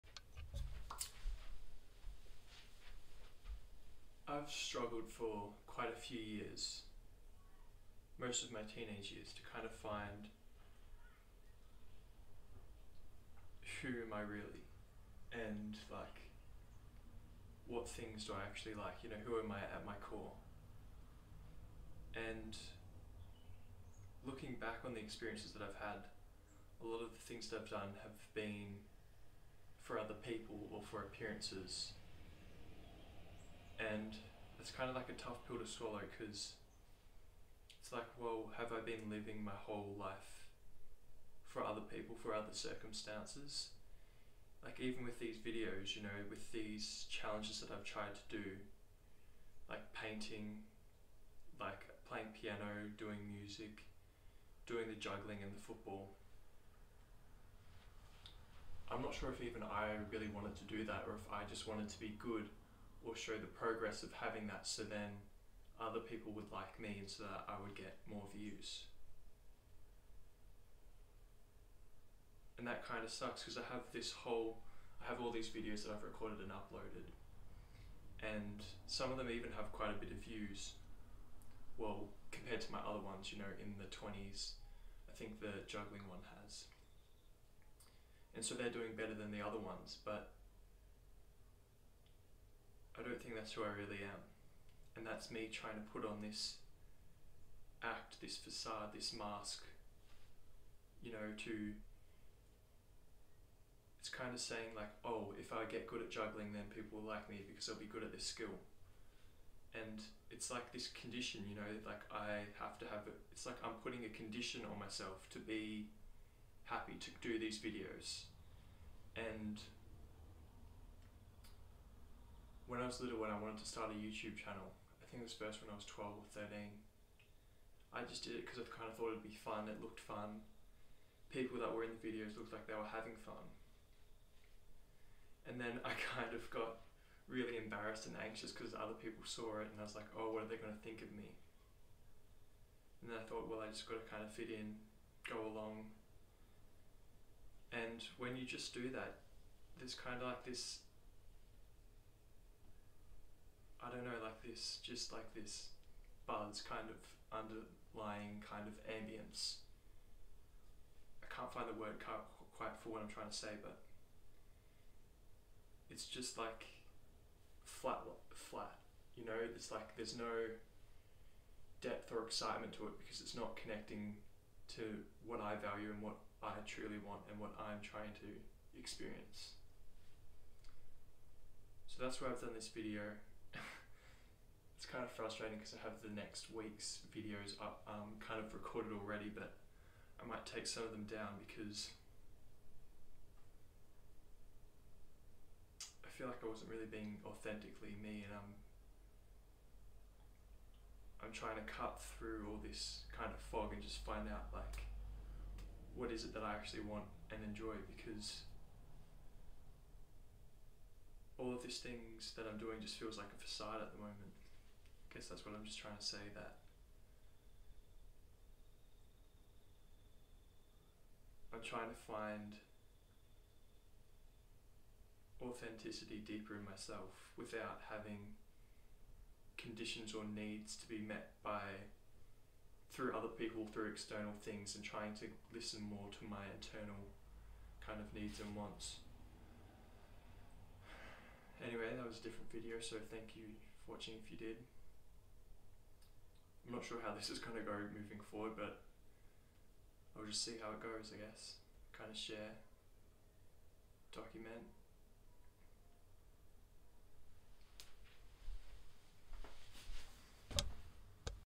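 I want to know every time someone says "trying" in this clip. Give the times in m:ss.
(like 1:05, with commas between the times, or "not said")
1:35, 2:43, 2:57, 3:21, 3:35, 3:41, 3:54.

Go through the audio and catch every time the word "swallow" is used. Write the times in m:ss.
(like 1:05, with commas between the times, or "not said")
0:35.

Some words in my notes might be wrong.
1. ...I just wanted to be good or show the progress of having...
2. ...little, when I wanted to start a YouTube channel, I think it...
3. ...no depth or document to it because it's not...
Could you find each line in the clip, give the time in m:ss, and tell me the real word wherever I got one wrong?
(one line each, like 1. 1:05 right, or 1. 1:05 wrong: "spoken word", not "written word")
1. 1:01 right
2. 2:03 right
3. 2:50 wrong: "excitement", not "document".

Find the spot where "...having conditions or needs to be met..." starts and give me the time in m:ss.
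3:47.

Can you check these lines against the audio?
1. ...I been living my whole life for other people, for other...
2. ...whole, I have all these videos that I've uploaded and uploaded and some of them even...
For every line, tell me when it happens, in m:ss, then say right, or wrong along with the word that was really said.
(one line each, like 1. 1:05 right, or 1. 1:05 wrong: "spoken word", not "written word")
1. 0:38 right
2. 1:14 wrong: "recorded", not "uploaded".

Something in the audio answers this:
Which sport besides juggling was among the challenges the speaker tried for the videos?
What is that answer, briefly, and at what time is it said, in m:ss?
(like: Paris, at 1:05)
football, at 0:55.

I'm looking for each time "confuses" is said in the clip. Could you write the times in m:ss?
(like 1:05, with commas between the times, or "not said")
not said.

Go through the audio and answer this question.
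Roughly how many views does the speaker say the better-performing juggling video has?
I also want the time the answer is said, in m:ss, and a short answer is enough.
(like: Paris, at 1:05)
in the 20s, at 1:23.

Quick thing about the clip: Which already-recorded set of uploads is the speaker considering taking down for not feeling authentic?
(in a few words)
next week's videos.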